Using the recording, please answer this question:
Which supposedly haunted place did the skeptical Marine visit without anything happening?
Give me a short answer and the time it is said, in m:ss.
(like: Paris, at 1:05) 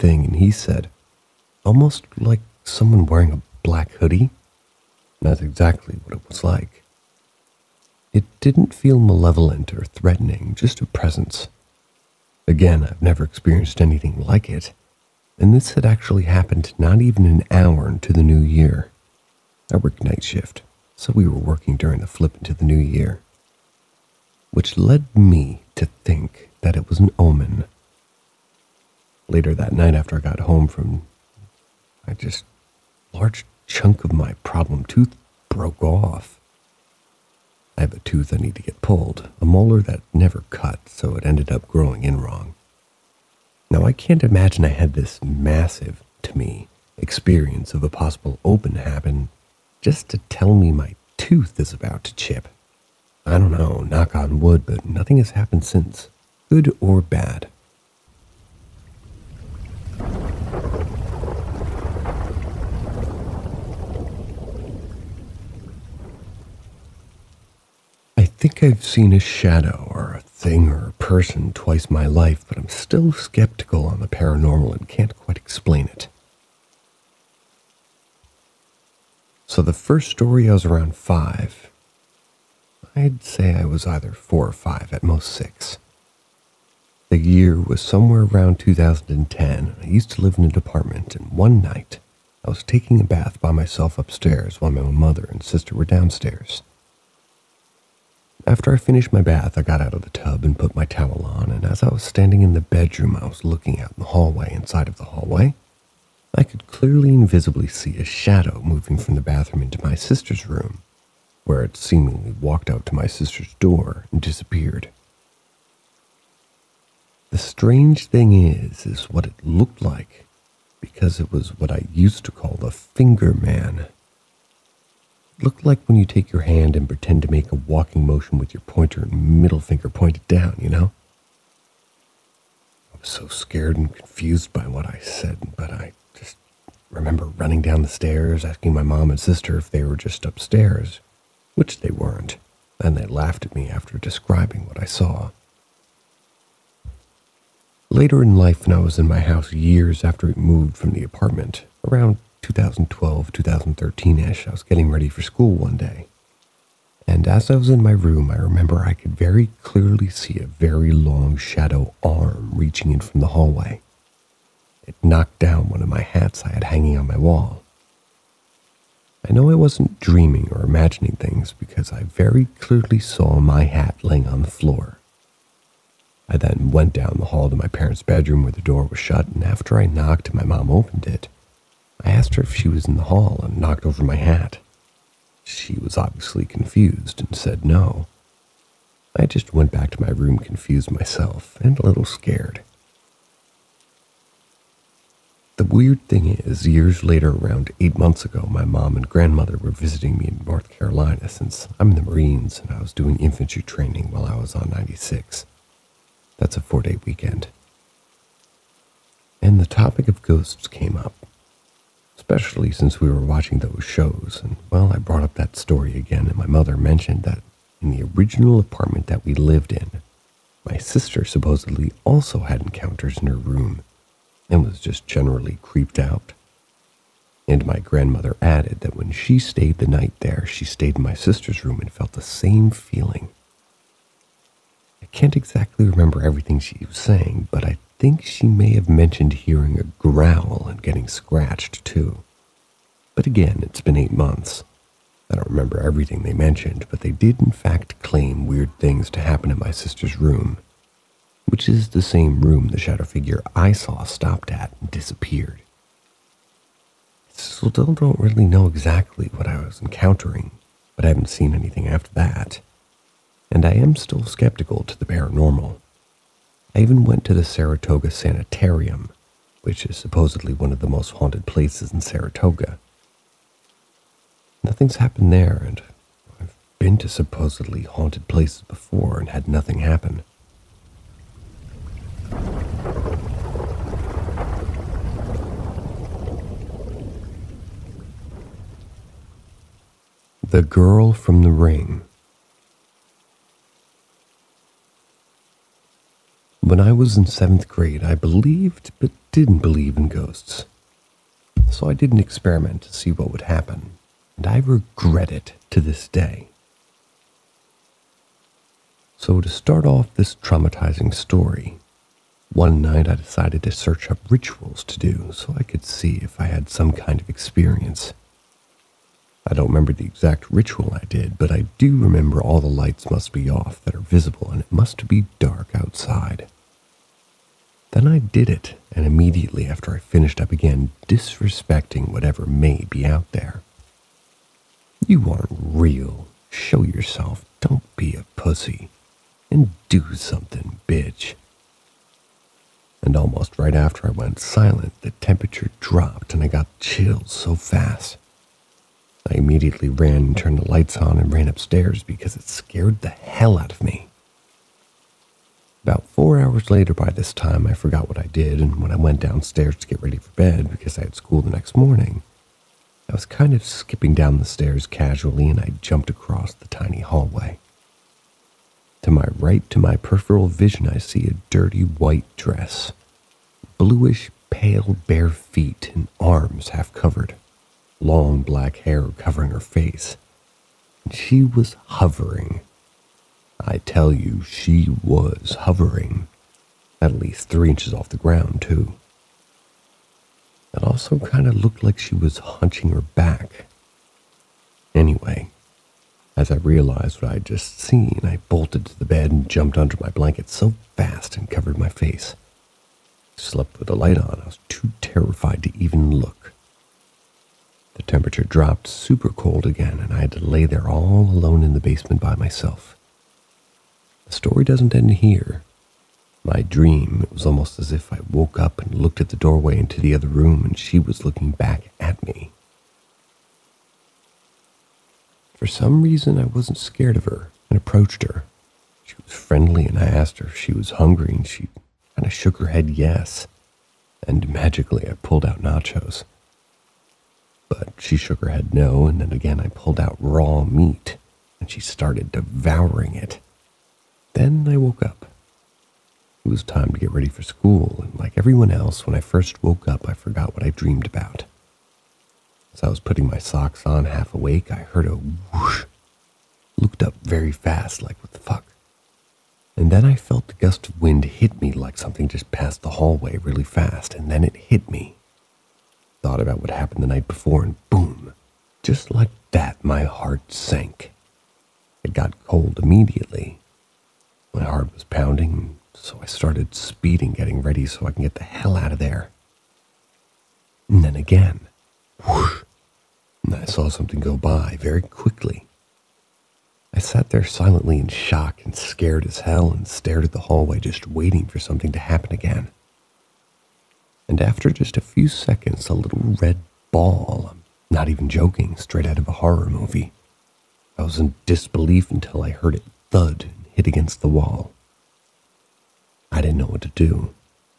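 Saratoga Sanitarium, at 4:27.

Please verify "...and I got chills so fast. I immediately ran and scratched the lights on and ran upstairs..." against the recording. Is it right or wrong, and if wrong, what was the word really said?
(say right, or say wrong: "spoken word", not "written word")
wrong: "turned", not "scratched".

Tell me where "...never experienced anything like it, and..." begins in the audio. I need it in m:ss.
0:13.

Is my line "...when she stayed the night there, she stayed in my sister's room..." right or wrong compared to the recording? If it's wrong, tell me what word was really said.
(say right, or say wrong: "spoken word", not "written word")
right.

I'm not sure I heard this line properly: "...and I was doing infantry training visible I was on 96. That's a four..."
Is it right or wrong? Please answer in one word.
wrong.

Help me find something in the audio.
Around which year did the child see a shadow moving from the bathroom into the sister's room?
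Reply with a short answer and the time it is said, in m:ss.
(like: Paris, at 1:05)
2010, at 1:28.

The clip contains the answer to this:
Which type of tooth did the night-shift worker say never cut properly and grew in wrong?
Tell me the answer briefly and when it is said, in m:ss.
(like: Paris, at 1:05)
molar, at 0:39.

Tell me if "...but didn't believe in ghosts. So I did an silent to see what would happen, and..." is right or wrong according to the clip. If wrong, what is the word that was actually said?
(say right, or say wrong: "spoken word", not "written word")
wrong: "experiment", not "silent".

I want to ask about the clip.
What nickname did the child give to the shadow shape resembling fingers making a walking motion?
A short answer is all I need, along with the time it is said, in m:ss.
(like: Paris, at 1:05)
the finger man, at 2:02.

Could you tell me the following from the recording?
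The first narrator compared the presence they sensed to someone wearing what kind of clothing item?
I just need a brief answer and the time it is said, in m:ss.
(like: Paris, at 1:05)
black hoodie, at 0:03.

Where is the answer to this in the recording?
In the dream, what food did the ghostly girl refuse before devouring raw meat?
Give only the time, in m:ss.
7:15.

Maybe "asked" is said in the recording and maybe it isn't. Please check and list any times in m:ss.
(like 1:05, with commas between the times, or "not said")
3:02, 7:10.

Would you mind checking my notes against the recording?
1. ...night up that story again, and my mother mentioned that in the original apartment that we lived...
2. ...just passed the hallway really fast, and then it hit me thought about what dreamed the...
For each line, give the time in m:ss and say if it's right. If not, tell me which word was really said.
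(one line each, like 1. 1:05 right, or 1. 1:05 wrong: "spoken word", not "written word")
1. 3:34 wrong: "brought", not "night"
2. 7:42 wrong: "happened", not "dreamed".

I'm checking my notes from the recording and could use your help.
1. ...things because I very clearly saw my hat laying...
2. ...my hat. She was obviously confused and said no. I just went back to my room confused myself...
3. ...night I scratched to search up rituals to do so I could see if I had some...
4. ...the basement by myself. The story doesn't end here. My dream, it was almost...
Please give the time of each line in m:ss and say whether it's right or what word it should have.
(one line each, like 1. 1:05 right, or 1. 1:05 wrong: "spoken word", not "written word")
1. 2:51 right
2. 3:04 right
3. 5:12 wrong: "decided", not "scratched"
4. 6:51 right.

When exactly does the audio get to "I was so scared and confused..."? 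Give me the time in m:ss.
2:12.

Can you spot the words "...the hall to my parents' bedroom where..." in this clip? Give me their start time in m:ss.
2:57.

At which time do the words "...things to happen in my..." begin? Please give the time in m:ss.
4:08.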